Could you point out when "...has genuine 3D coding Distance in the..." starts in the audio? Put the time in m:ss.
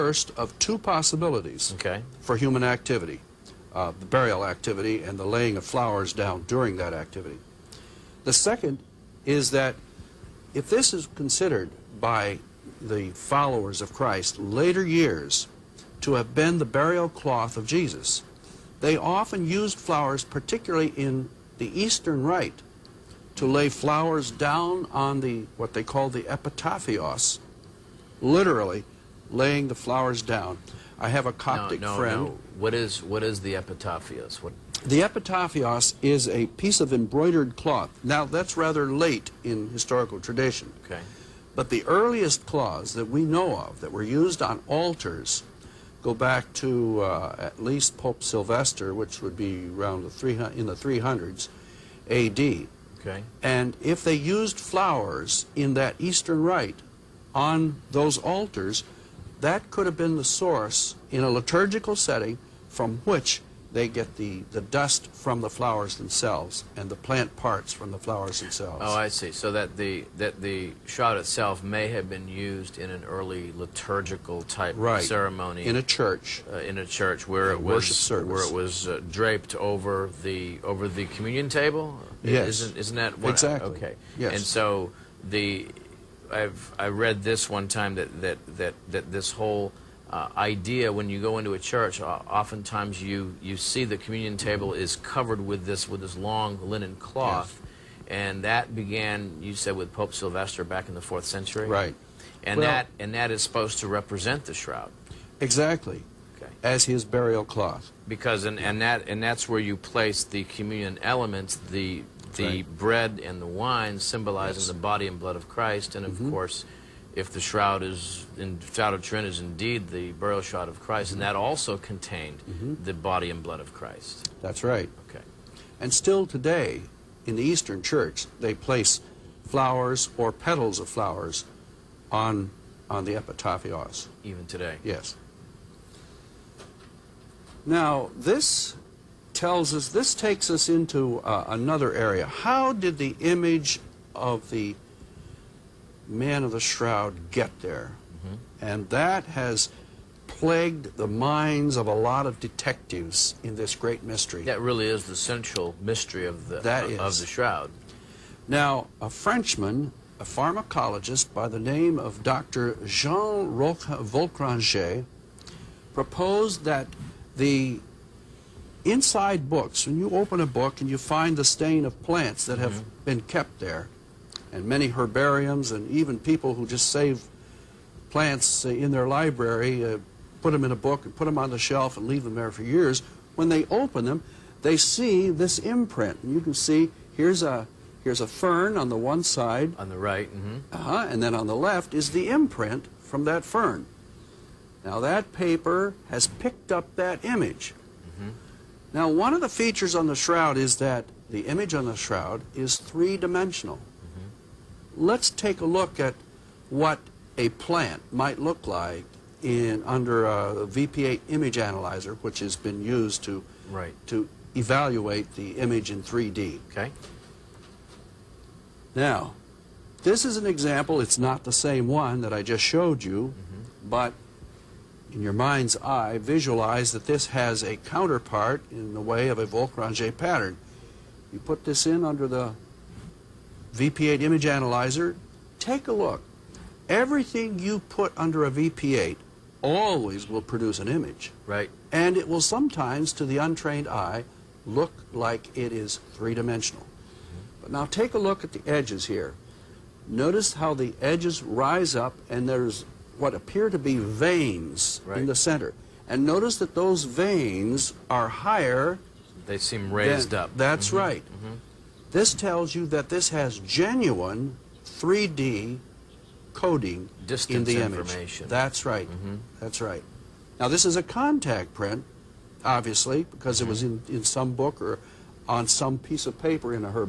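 4:23.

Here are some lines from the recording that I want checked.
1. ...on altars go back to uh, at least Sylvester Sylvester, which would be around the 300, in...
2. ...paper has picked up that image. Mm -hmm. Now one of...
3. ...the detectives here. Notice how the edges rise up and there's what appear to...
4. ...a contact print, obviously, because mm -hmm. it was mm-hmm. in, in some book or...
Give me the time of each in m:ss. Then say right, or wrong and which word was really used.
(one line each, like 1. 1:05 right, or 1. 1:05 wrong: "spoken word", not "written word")
1. 0:44 wrong: "Pope", not "Sylvester"
2. 3:15 right
3. 4:08 wrong: "edges", not "detectives"
4. 4:30 right.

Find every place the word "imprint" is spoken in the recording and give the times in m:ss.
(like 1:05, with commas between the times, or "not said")
3:05, 3:12.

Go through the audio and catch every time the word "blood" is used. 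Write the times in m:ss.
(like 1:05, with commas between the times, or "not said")
1:55, 2:03.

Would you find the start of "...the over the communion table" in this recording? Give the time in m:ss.
1:20.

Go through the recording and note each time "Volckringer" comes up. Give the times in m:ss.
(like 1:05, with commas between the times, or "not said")
2:44, 3:49.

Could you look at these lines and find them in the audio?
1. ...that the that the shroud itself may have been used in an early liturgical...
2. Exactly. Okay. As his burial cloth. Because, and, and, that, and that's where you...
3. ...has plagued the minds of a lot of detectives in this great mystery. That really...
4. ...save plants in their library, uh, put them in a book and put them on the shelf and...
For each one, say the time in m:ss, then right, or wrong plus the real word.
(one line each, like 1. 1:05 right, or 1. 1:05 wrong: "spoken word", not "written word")
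1. 1:09 right
2. 1:45 right
3. 2:29 right
4. 2:56 right.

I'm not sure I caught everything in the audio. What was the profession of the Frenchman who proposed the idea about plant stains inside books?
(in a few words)
pharmacologist.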